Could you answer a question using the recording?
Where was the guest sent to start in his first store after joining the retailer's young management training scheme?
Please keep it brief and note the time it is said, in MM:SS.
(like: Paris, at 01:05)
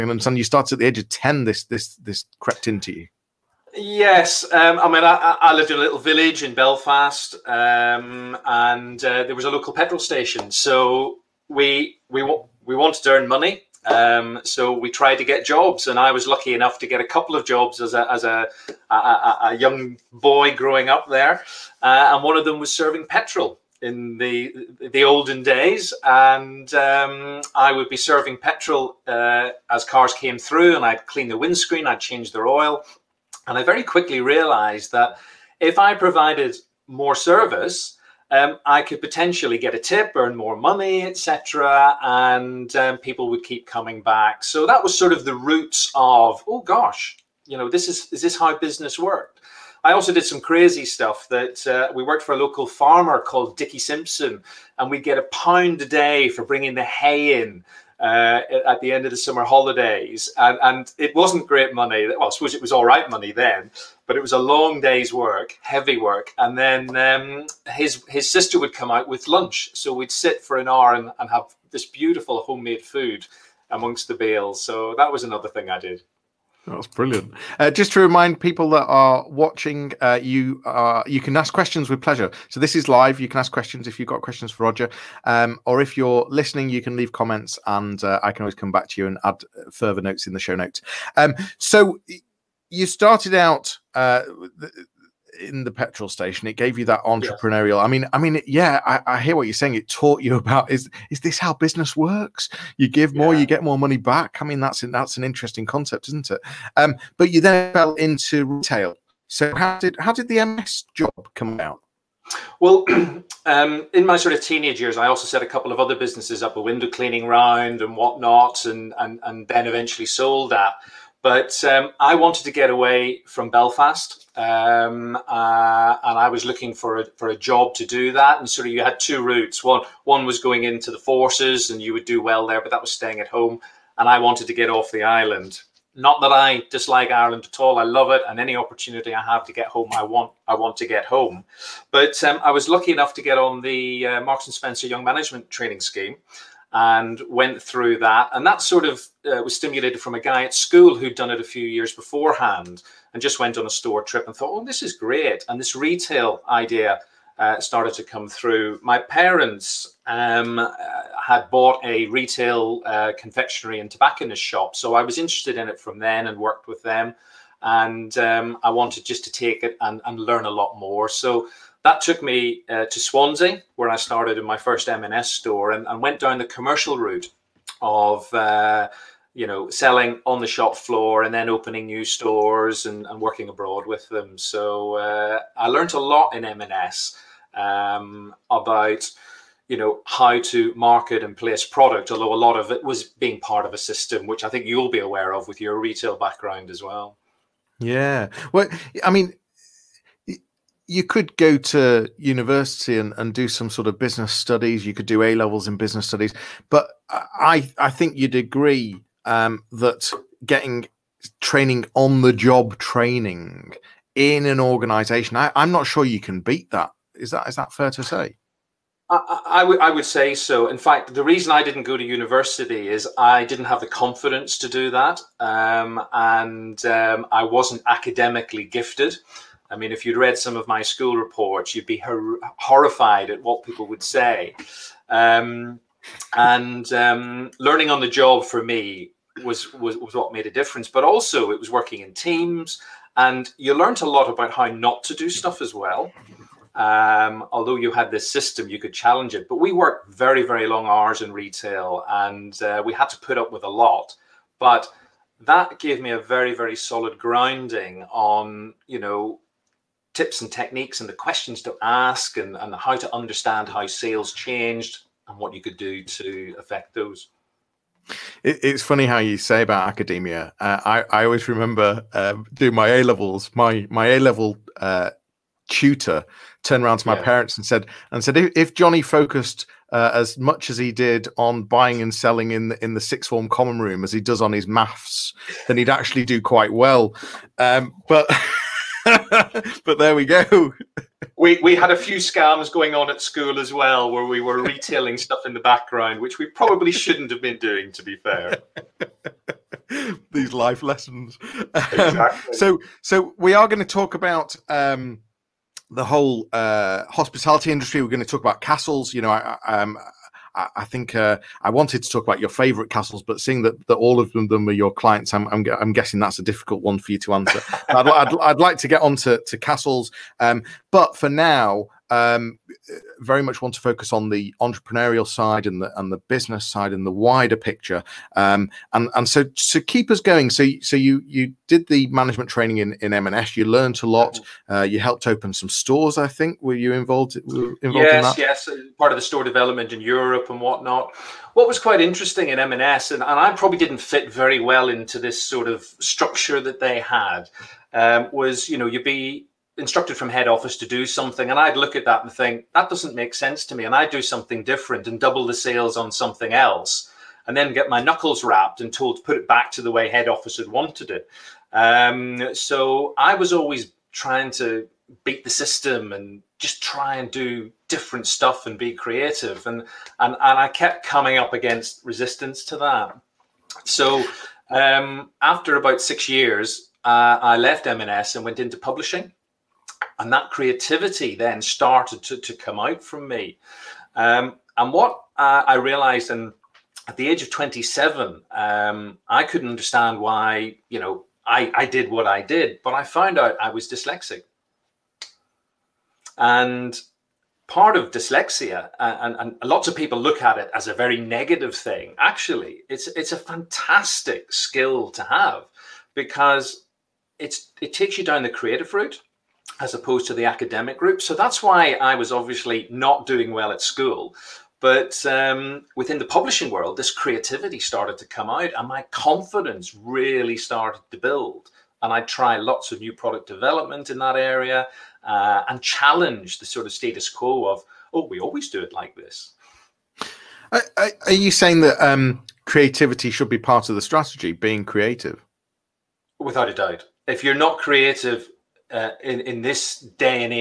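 Swansea, at 02:52.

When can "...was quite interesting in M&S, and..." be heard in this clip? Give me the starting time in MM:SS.
05:41.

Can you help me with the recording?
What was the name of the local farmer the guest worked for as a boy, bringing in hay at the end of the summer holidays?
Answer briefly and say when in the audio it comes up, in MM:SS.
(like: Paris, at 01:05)
Dickie Simpson, at 00:53.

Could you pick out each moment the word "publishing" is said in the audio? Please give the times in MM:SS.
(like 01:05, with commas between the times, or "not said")
06:18, 06:56.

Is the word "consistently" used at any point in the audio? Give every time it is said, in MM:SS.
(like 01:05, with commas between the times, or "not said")
not said.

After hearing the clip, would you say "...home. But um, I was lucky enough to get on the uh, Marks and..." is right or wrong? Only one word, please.
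right.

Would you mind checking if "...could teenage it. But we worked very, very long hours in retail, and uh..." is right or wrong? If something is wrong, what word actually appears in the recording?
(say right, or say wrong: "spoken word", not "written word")
wrong: "challenge", not "teenage".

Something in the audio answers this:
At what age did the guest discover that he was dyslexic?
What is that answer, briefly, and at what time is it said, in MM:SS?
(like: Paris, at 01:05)
27, at 06:27.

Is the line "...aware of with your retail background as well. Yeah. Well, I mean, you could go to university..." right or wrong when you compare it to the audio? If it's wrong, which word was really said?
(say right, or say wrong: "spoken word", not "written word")
right.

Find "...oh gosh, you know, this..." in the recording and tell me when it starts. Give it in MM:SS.
00:46.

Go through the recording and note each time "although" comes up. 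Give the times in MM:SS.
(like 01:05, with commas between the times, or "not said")
03:12, 04:07.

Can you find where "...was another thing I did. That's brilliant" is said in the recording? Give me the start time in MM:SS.
01:15.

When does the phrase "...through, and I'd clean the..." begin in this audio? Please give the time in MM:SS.
00:30.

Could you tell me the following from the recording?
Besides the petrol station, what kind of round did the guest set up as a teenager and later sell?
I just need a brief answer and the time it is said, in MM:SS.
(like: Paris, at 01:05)
window cleaning round, at 01:56.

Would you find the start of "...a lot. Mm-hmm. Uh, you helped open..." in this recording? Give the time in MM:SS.
05:34.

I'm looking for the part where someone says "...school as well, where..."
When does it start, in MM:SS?
04:53.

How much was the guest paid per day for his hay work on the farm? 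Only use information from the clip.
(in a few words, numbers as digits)
a pound.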